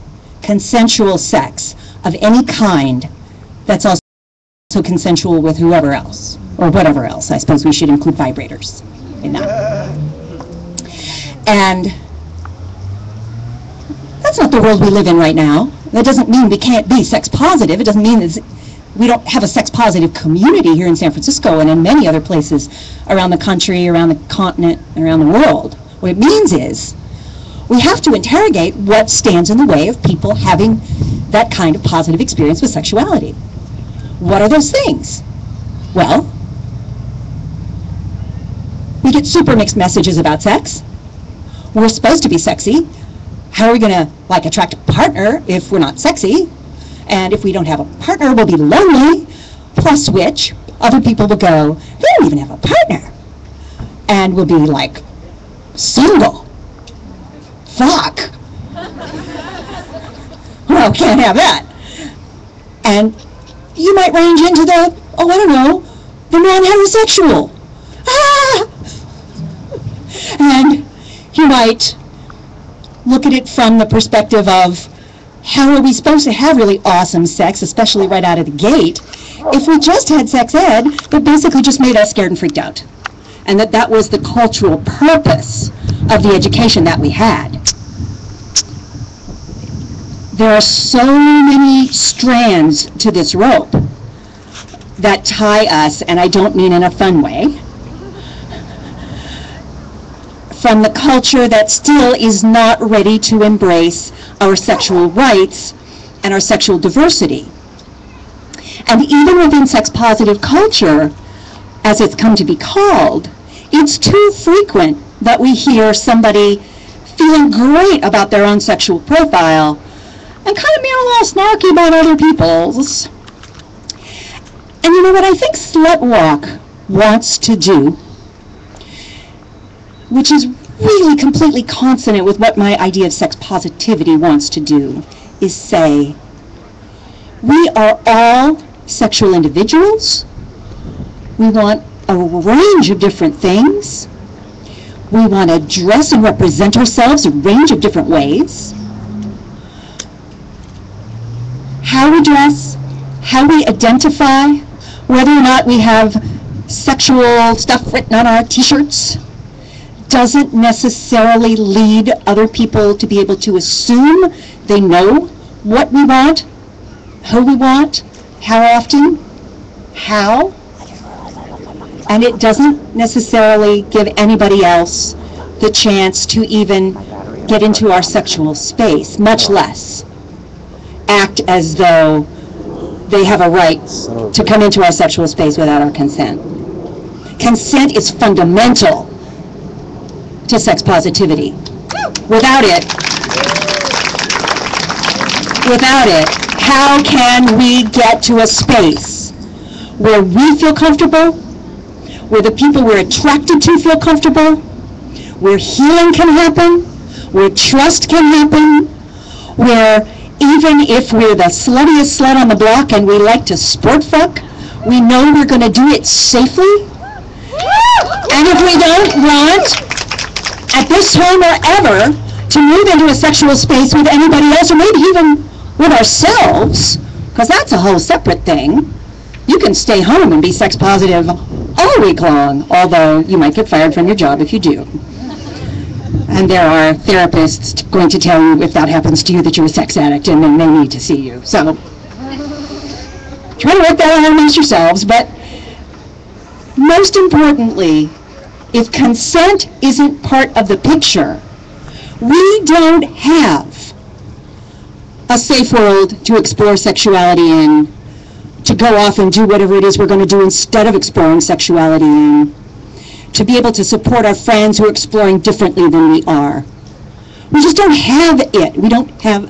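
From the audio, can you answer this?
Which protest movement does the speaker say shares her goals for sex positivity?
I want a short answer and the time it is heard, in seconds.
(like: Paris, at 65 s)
SlutWalk, at 125 s.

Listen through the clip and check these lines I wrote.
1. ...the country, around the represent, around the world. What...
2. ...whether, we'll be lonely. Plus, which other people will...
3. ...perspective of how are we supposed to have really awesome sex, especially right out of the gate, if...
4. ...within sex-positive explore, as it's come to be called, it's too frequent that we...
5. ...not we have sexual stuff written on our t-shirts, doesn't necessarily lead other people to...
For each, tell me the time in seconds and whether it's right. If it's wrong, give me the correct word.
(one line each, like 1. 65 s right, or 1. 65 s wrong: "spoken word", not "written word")
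1. 23 s wrong: "continent", not "represent"
2. 48 s wrong: "partner", not "whether"
3. 73 s right
4. 109 s wrong: "culture", not "explore"
5. 155 s right.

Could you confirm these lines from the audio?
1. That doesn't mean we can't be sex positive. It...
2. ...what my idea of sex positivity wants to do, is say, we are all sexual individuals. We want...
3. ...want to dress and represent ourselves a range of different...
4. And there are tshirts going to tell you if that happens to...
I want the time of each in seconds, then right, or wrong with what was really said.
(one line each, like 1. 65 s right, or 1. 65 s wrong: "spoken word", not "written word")
1. 15 s right
2. 132 s right
3. 145 s right
4. 236 s wrong: "therapists", not "tshirts".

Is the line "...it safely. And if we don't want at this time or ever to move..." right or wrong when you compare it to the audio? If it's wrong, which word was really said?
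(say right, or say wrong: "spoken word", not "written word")
right.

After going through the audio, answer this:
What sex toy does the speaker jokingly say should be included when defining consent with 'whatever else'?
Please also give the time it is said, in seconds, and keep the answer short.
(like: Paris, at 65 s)
vibrators, at 8 s.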